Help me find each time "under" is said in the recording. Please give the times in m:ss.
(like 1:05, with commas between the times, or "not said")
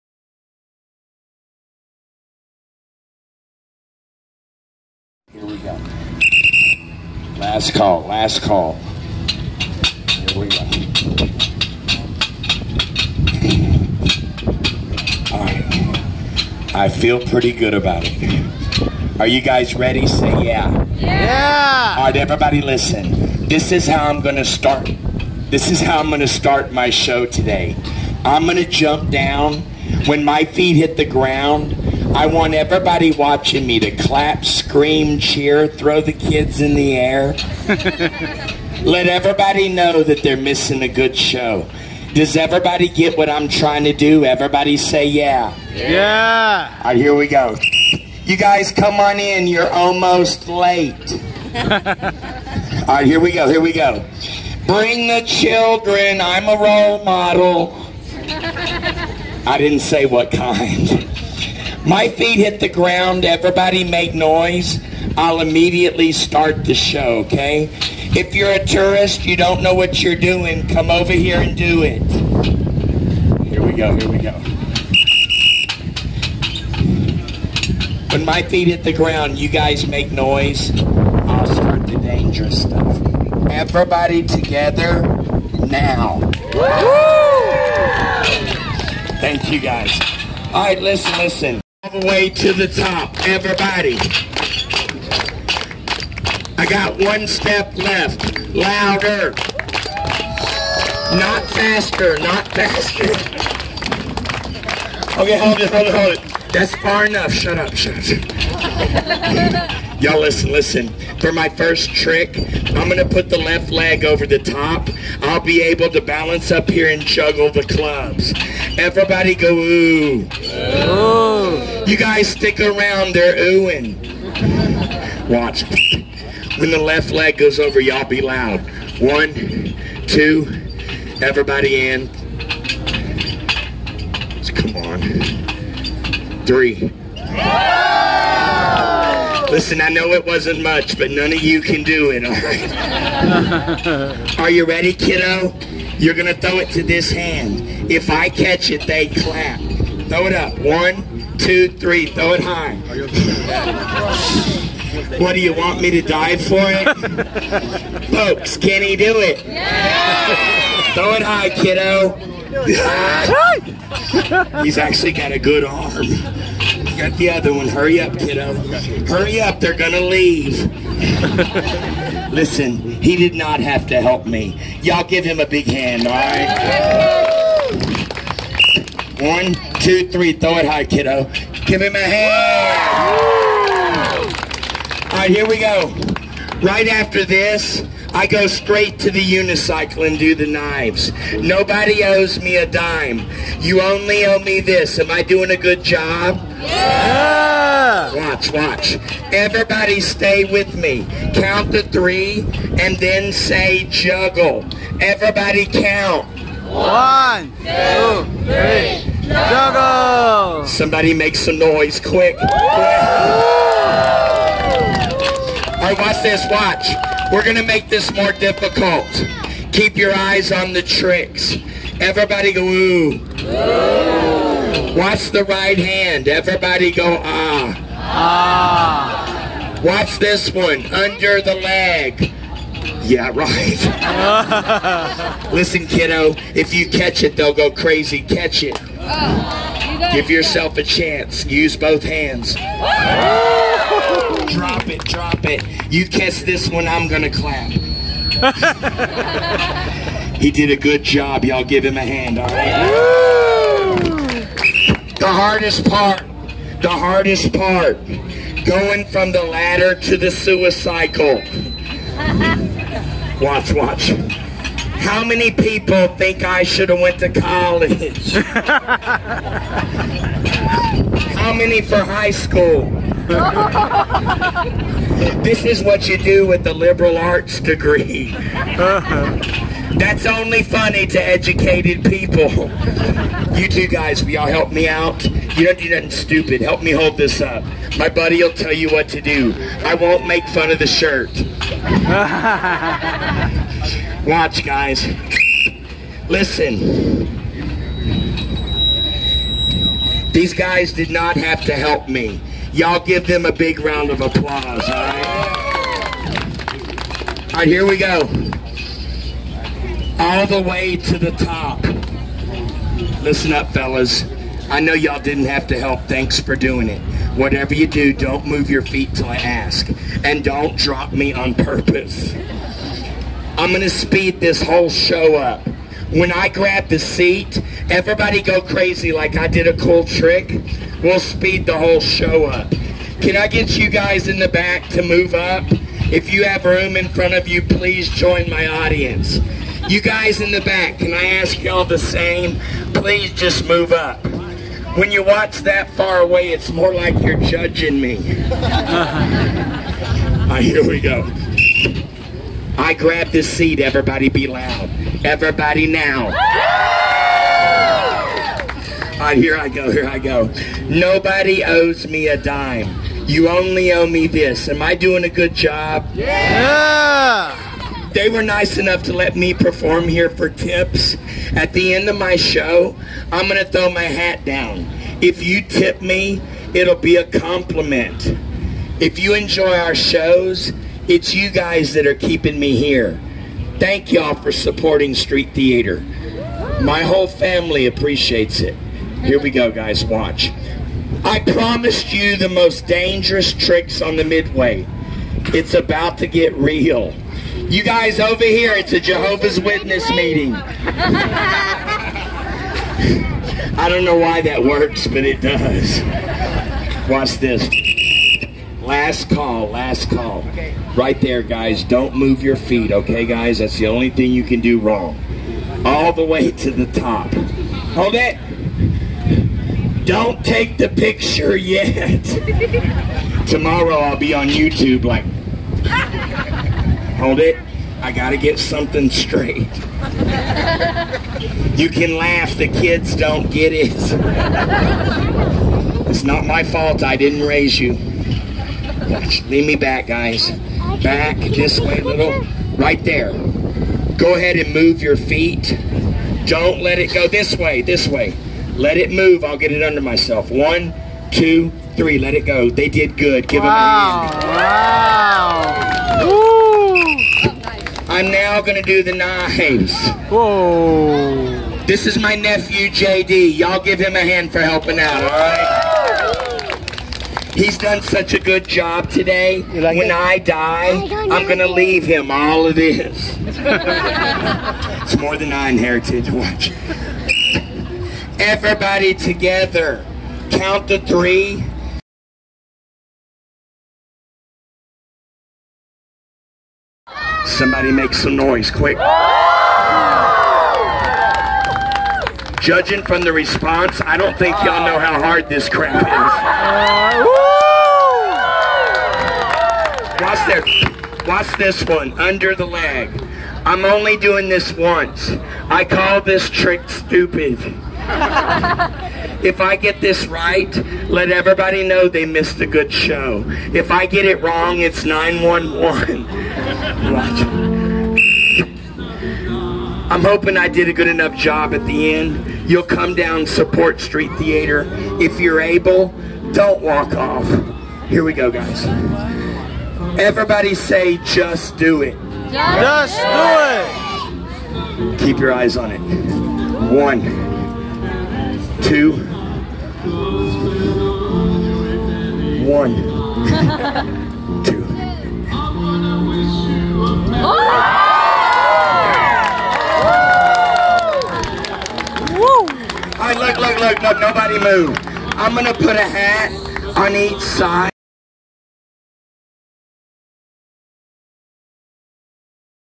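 3:50, 7:29, 8:22.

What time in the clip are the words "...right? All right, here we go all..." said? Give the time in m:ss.
5:04.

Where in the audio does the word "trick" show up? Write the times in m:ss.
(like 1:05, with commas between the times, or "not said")
1:51, 3:40, 5:30, 6:33, 8:26.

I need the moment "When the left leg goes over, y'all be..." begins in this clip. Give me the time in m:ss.
2:06.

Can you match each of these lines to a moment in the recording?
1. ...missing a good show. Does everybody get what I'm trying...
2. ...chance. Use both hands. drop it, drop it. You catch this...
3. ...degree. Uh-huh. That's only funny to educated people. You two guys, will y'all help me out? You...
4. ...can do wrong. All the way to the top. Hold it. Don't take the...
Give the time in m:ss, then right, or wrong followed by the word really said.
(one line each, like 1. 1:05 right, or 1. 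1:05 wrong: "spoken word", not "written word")
1. 0:40 right
2. 4:00 right
3. 4:37 right
4. 6:54 right.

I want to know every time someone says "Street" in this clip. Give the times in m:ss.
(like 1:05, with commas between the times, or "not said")
6:25, 8:43.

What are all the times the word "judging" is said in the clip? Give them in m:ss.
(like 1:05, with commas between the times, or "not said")
5:47, 8:12.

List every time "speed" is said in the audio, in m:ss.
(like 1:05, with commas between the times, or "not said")
5:23, 5:31.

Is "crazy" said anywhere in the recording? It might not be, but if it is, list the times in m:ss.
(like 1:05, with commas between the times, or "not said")
3:57, 5:28.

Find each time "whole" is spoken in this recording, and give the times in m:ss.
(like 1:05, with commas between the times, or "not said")
5:24, 5:31, 6:27.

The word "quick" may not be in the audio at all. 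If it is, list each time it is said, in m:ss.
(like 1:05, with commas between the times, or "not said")
3:32, 8:08.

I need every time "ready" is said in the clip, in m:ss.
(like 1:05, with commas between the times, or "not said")
0:19, 2:24.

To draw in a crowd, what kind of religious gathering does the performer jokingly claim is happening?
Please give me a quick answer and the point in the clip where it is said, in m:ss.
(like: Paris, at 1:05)
Jehovah's Witness meeting, at 6:38.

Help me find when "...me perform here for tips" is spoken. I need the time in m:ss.
6:09.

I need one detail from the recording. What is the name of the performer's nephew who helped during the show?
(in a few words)
JD.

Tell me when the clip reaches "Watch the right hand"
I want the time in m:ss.
3:44.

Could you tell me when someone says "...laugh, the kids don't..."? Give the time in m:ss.
7:12.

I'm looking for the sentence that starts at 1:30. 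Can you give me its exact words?
All right, listen, listen all the way to the top, everybody.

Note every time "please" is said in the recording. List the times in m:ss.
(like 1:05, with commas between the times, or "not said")
5:37, 5:42.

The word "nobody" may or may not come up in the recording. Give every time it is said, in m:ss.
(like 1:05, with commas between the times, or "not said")
3:11, 6:00, 9:14.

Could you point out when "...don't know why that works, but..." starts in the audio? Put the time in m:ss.
6:43.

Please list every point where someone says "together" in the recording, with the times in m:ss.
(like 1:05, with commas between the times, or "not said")
1:24, 7:59.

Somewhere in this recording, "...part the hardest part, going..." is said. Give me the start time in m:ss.
4:15.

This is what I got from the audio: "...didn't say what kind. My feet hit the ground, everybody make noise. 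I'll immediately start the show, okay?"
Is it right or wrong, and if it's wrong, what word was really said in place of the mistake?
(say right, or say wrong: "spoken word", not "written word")
right.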